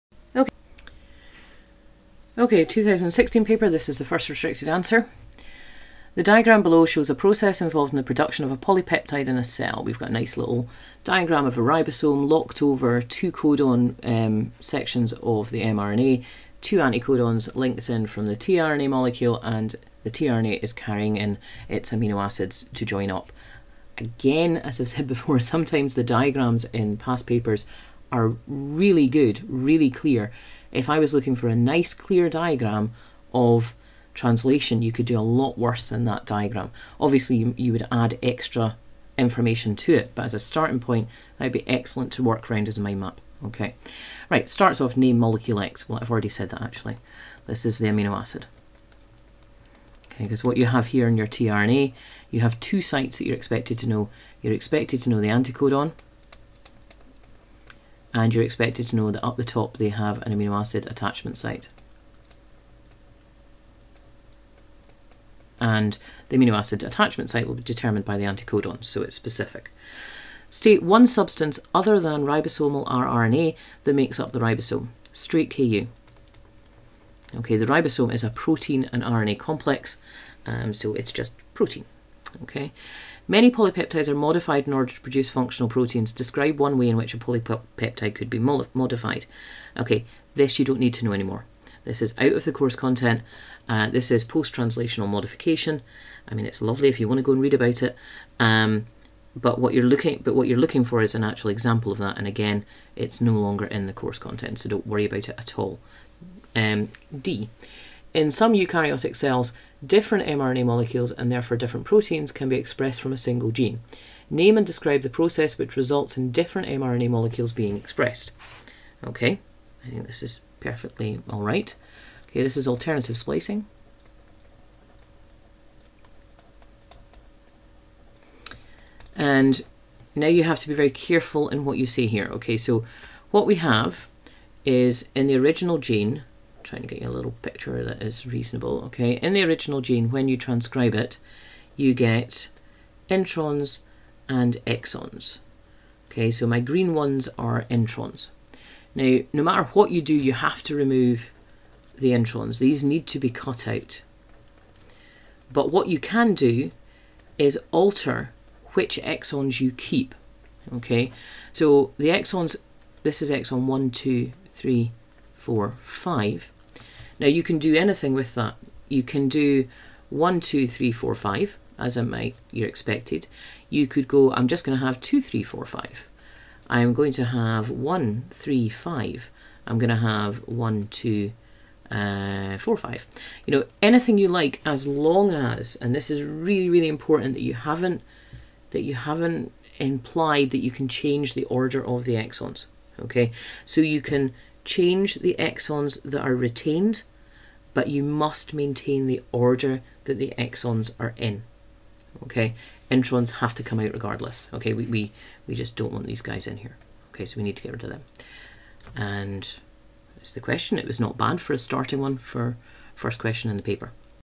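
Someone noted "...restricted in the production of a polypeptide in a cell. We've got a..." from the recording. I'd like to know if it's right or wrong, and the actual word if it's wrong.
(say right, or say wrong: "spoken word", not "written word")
wrong: "involved", not "restricted".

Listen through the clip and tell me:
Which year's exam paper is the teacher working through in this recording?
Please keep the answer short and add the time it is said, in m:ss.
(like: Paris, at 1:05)
2016, at 0:02.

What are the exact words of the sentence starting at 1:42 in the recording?
And again, it's no longer in the course content, so don't worry about it at all.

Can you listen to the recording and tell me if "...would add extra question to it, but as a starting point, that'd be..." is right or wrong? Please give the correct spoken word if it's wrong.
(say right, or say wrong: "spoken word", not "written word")
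wrong: "information", not "question".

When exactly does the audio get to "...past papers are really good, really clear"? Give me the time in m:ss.
0:26.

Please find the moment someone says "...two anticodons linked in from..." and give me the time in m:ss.
0:16.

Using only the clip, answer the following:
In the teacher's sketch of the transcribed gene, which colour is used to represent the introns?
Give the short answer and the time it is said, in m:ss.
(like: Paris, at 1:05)
green, at 2:26.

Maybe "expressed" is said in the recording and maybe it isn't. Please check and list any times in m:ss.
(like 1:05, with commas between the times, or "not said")
1:52, 1:57.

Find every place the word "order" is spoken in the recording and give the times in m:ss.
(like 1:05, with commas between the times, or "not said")
1:24, 3:11, 3:19.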